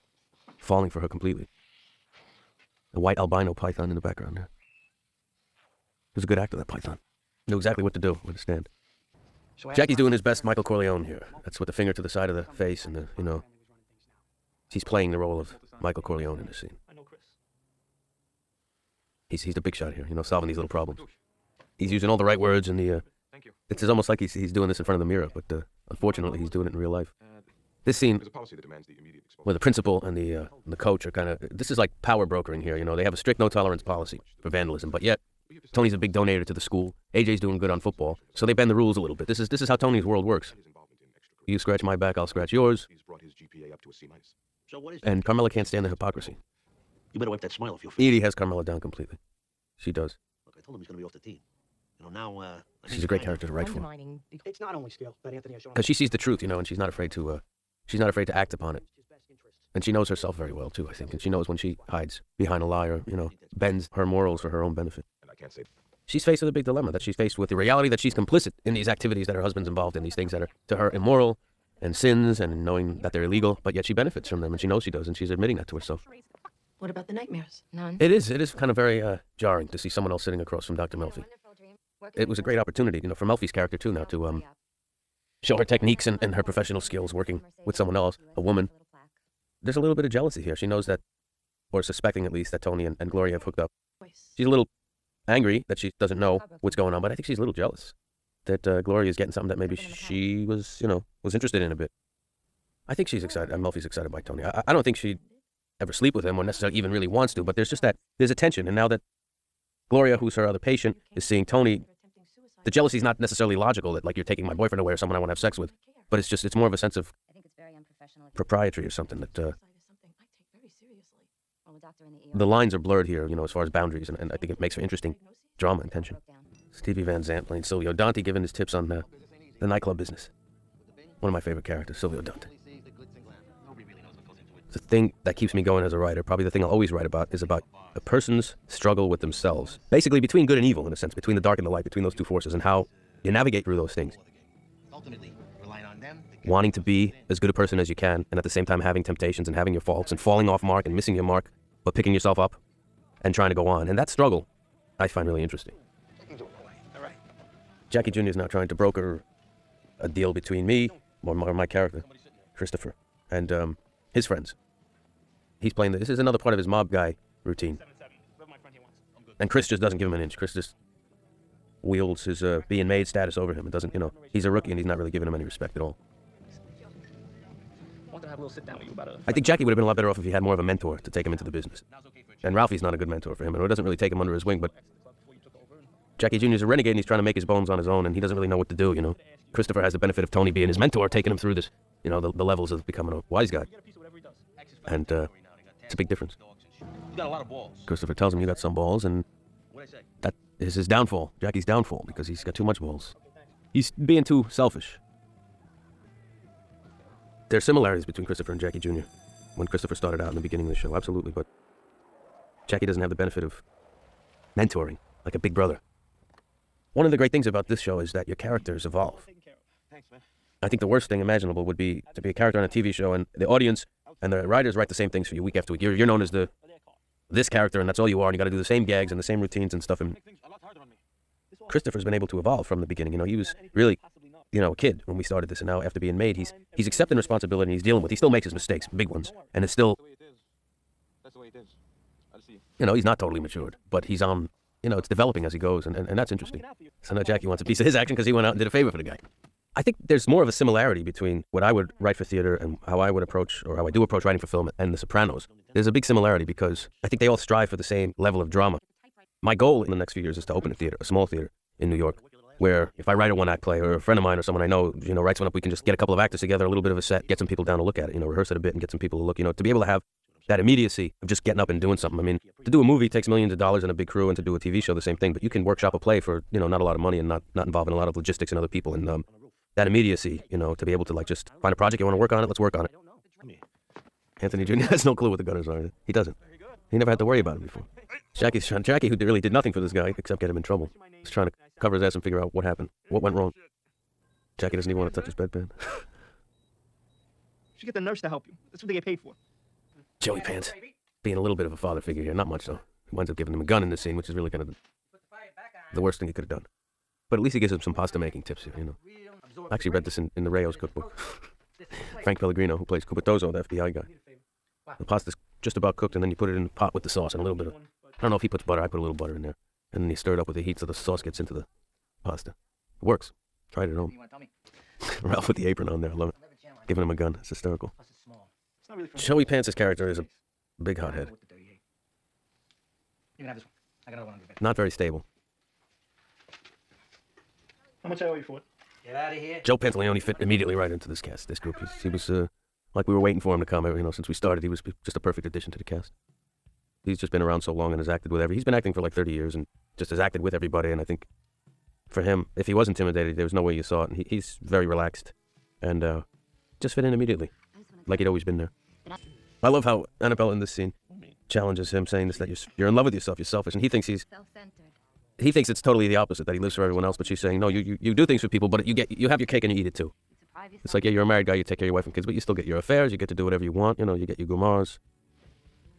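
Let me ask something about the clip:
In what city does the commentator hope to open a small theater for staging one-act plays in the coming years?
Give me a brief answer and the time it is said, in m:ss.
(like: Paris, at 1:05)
New York, at 4:21.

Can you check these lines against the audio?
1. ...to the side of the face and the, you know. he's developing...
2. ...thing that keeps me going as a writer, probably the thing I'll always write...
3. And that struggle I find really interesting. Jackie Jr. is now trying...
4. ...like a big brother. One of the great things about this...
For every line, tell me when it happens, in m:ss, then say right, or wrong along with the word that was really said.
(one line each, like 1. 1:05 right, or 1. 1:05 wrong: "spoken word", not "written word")
1. 0:11 wrong: "playing", not "developing"
2. 2:14 right
3. 2:33 right
4. 3:35 right.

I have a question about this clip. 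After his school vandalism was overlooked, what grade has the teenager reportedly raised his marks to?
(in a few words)
C minus.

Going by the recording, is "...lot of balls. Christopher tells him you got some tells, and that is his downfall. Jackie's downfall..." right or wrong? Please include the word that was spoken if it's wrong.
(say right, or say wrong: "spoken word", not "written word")
wrong: "balls", not "tells".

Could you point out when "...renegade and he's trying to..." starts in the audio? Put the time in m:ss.
3:06.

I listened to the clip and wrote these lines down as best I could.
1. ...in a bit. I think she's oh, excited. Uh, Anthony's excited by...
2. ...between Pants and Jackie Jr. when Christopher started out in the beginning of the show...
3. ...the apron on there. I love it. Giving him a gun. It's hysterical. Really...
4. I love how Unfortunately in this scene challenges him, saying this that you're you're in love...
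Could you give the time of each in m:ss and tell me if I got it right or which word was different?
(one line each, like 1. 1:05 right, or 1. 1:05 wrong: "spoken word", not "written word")
1. 1:41 wrong: "Melfi", not "Anthony"
2. 3:28 wrong: "Christopher", not "Pants"
3. 5:25 right
4. 5:59 wrong: "Annabella", not "Unfortunately".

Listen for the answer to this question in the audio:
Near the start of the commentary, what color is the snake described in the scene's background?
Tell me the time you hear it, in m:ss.
0:03.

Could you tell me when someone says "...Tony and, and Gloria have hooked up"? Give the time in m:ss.
1:32.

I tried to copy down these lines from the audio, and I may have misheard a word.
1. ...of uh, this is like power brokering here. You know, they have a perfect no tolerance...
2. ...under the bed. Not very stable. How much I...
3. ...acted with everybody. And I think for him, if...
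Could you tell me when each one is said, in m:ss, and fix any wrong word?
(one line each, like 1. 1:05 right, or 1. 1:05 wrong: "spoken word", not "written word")
1. 0:31 wrong: "strict", not "perfect"
2. 5:34 right
3. 5:50 right.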